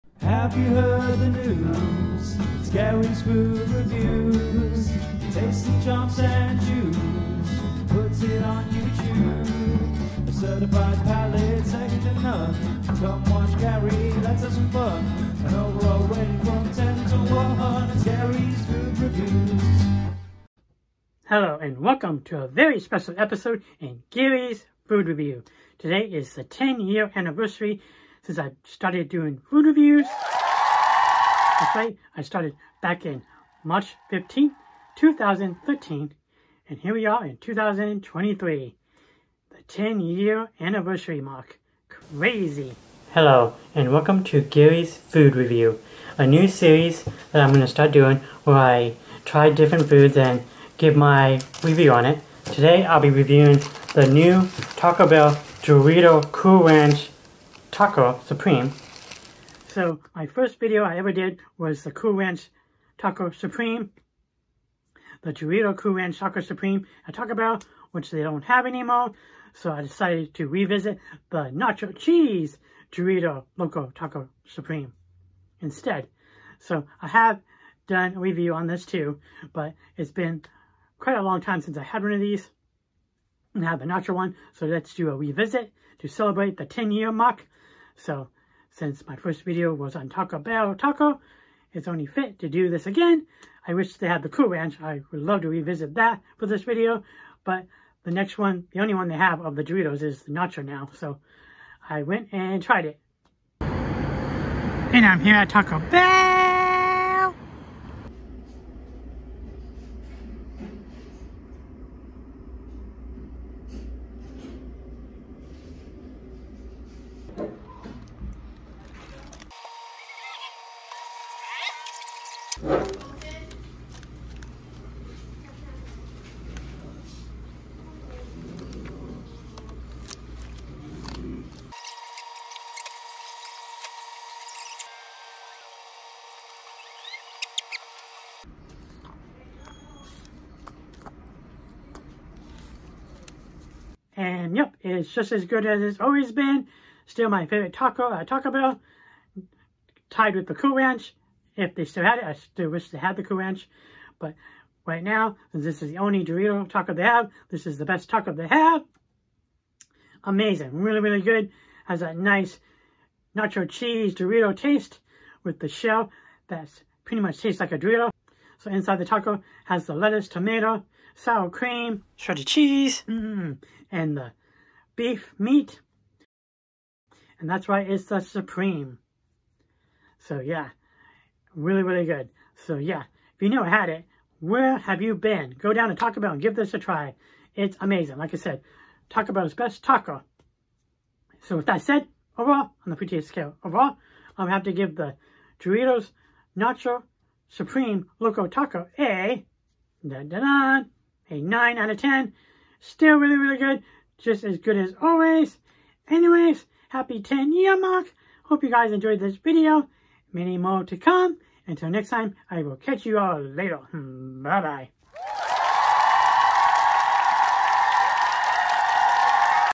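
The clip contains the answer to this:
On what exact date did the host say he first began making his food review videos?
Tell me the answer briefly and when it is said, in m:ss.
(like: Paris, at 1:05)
March 15, 2013, at 0:33.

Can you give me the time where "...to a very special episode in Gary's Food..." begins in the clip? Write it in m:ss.
0:22.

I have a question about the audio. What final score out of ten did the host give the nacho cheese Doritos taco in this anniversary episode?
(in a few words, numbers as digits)
9.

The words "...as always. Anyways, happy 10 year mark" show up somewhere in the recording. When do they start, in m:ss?
3:24.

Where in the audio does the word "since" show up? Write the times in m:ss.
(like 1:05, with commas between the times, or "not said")
0:28, 1:21, 1:28.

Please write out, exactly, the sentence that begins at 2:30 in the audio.
Tied with the Cool Ranch if they still had it.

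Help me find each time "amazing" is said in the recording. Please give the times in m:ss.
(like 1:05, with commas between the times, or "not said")
2:40, 3:07.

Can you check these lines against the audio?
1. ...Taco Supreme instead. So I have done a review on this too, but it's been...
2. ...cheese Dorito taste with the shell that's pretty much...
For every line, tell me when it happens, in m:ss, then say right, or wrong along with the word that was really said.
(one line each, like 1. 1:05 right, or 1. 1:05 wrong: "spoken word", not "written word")
1. 1:13 right
2. 2:43 right.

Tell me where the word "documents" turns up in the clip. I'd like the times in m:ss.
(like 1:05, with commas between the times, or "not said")
not said.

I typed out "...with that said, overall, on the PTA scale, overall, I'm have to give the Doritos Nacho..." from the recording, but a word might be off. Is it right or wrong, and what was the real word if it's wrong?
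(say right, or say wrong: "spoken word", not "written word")
right.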